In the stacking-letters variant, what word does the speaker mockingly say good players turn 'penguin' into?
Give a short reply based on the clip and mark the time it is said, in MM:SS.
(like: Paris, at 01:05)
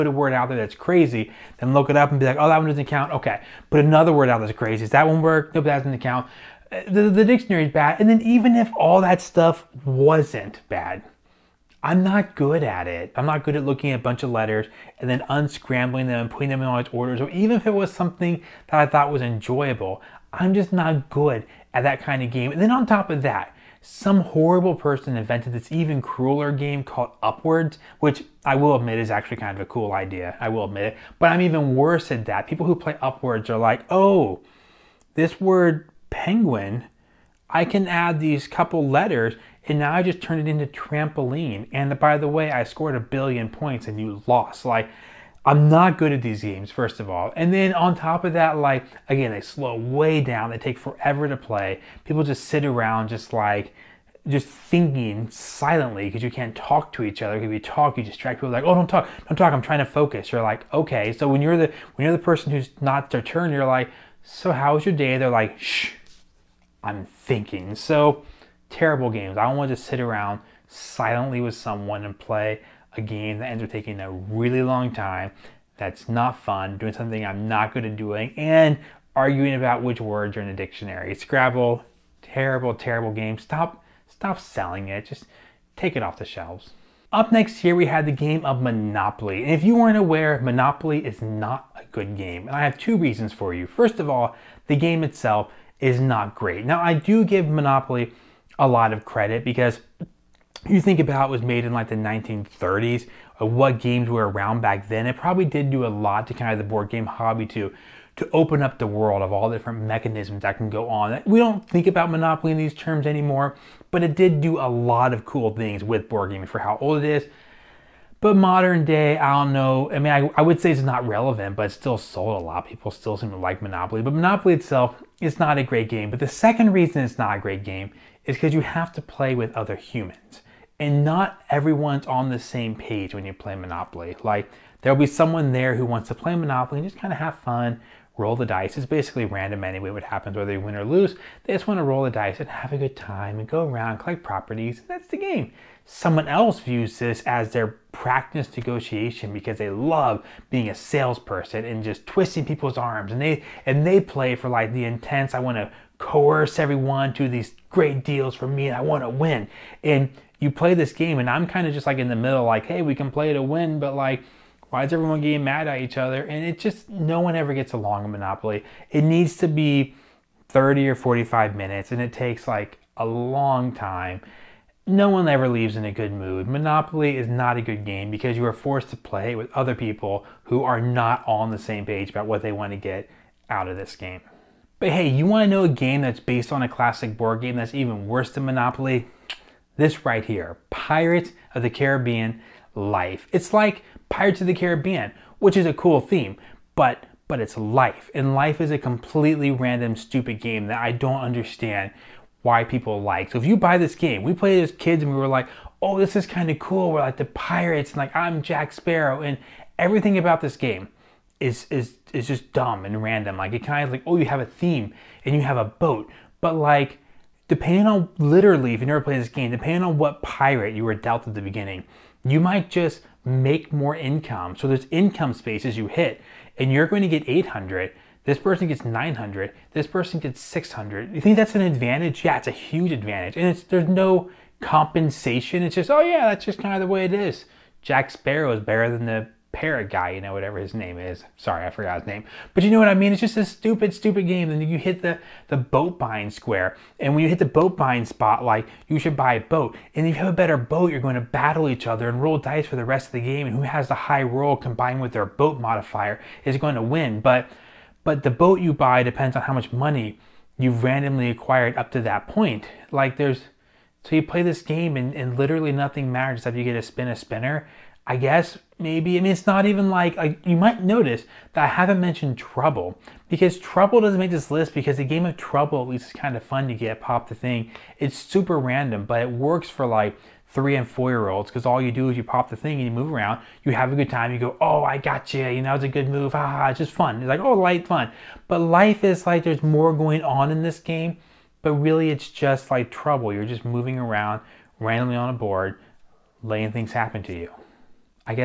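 trampoline, at 00:40.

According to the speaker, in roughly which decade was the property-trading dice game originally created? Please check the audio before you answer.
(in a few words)
1930s.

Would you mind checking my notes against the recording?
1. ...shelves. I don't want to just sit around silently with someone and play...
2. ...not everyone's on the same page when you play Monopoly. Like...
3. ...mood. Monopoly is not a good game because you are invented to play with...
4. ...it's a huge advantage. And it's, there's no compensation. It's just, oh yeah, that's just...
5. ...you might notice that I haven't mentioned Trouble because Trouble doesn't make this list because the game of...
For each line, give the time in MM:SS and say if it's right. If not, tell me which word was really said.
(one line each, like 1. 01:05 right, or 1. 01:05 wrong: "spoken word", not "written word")
1. 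01:09 wrong: "games", not "shelves"
2. 02:11 right
3. 02:56 wrong: "forced", not "invented"
4. 03:52 right
5. 04:30 right.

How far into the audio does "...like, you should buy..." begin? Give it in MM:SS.
04:08.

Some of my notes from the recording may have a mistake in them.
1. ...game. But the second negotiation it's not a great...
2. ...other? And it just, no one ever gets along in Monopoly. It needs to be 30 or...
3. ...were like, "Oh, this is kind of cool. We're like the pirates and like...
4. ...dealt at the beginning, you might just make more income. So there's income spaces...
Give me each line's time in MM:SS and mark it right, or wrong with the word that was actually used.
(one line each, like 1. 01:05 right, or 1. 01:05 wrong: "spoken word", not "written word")
1. 02:05 wrong: "reason", not "negotiation"
2. 02:45 right
3. 03:25 right
4. 03:40 right.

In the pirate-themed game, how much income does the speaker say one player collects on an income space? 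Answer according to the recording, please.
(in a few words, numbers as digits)
900.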